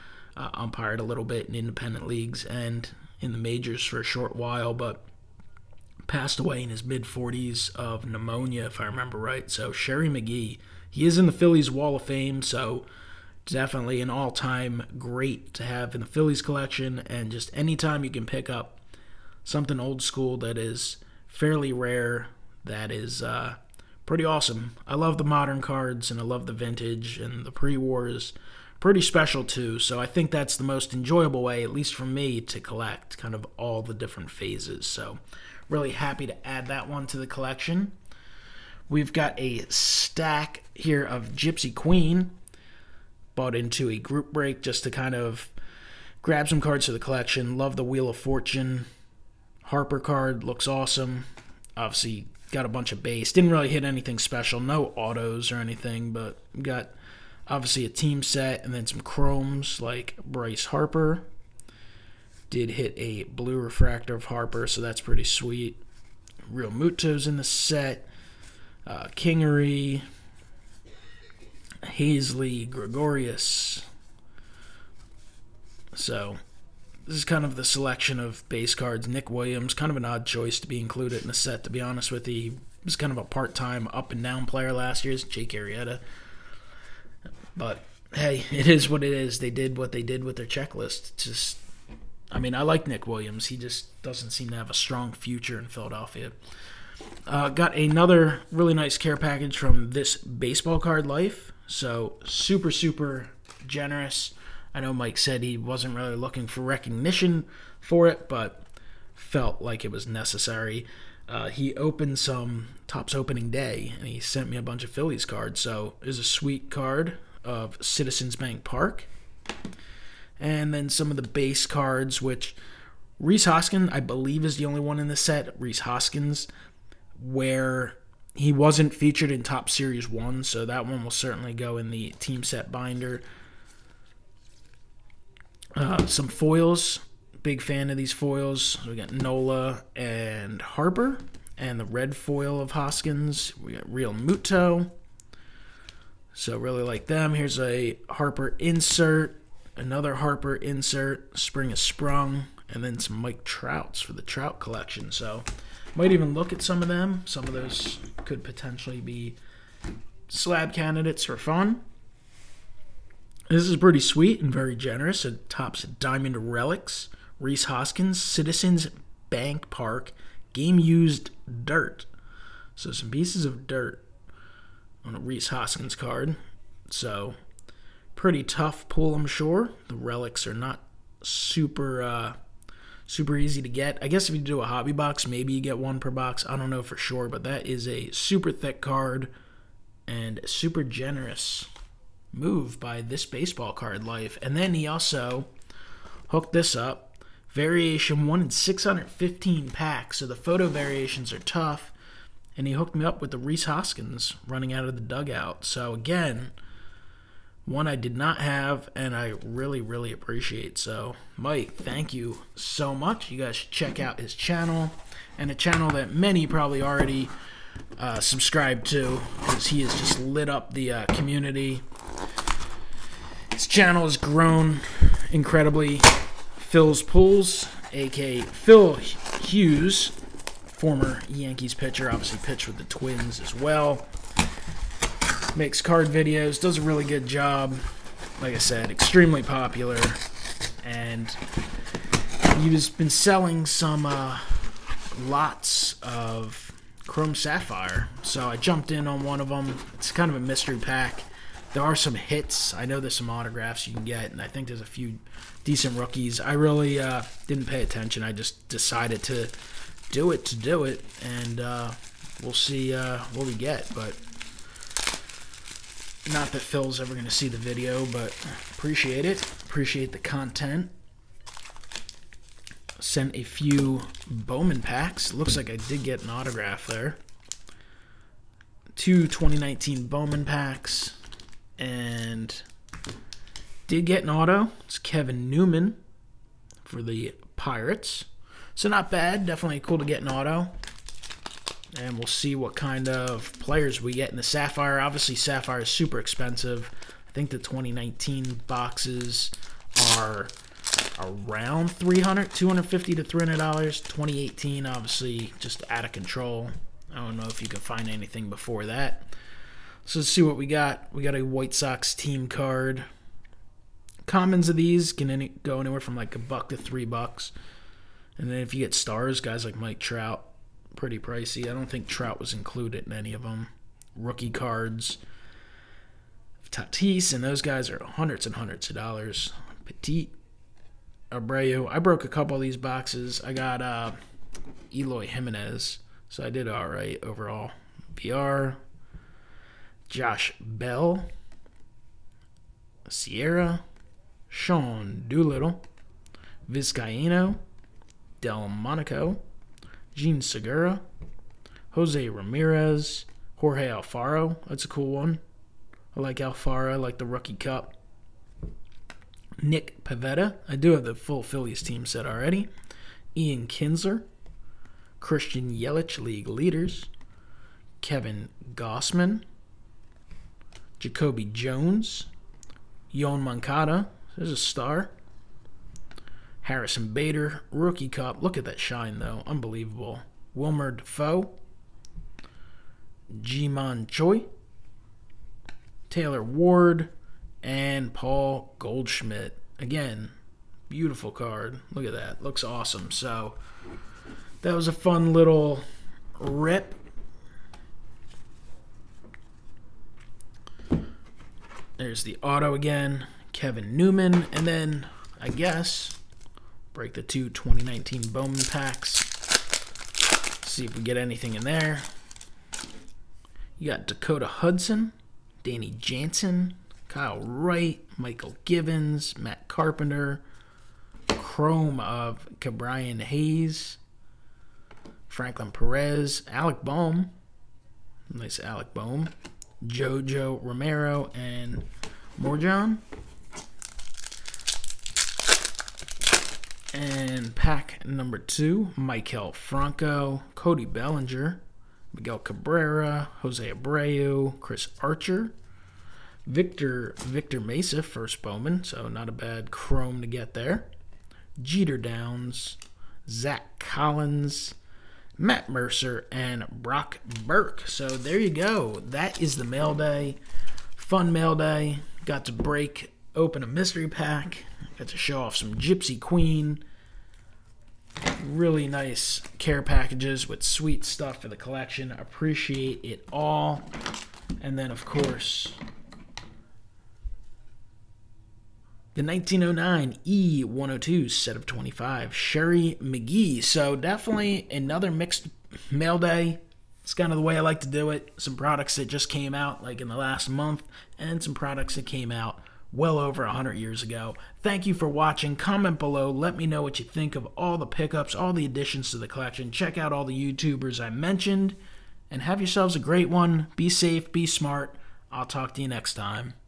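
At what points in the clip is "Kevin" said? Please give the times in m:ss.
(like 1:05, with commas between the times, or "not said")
4:44, 6:08, 6:43.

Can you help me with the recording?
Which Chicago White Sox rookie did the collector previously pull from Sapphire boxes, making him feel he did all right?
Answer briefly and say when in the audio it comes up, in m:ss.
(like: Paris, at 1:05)
Eloy Jimenez, at 5:34.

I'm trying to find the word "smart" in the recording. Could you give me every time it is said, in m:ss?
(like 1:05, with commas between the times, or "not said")
8:24.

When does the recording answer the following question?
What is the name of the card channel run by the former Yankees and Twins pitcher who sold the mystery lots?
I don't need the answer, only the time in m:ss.
3:46.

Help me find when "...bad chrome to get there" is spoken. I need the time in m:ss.
7:29.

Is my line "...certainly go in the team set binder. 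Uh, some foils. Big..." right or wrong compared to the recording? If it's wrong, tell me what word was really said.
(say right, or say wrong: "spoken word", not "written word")
right.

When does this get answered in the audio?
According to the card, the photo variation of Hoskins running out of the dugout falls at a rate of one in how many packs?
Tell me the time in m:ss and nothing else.
3:18.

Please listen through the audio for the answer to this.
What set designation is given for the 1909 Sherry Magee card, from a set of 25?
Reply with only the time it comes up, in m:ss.
8:00.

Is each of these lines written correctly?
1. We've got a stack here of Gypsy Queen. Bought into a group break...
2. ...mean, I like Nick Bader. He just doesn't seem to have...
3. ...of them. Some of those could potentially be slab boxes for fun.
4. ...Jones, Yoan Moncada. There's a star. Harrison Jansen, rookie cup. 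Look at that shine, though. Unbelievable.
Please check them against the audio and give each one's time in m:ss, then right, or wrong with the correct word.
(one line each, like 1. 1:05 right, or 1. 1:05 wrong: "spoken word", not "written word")
1. 0:38 right
2. 1:32 wrong: "Williams", not "Bader"
3. 2:36 wrong: "candidates", not "boxes"
4. 6:11 wrong: "Bader", not "Jansen".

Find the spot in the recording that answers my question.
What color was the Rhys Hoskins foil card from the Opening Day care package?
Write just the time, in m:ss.
2:21.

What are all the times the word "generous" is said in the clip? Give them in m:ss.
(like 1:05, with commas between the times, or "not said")
1:43, 2:44, 3:10.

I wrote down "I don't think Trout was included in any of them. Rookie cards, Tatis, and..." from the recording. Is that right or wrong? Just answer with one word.
right.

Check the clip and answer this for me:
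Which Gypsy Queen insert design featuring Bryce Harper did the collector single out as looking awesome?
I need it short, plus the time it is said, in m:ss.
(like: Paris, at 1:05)
Wheel of Fortune, at 0:47.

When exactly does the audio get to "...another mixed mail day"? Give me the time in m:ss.
8:04.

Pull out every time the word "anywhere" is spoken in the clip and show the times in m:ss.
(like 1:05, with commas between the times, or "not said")
5:15.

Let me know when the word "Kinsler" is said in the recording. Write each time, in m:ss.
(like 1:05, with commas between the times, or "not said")
6:03.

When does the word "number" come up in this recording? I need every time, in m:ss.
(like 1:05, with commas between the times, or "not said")
7:18.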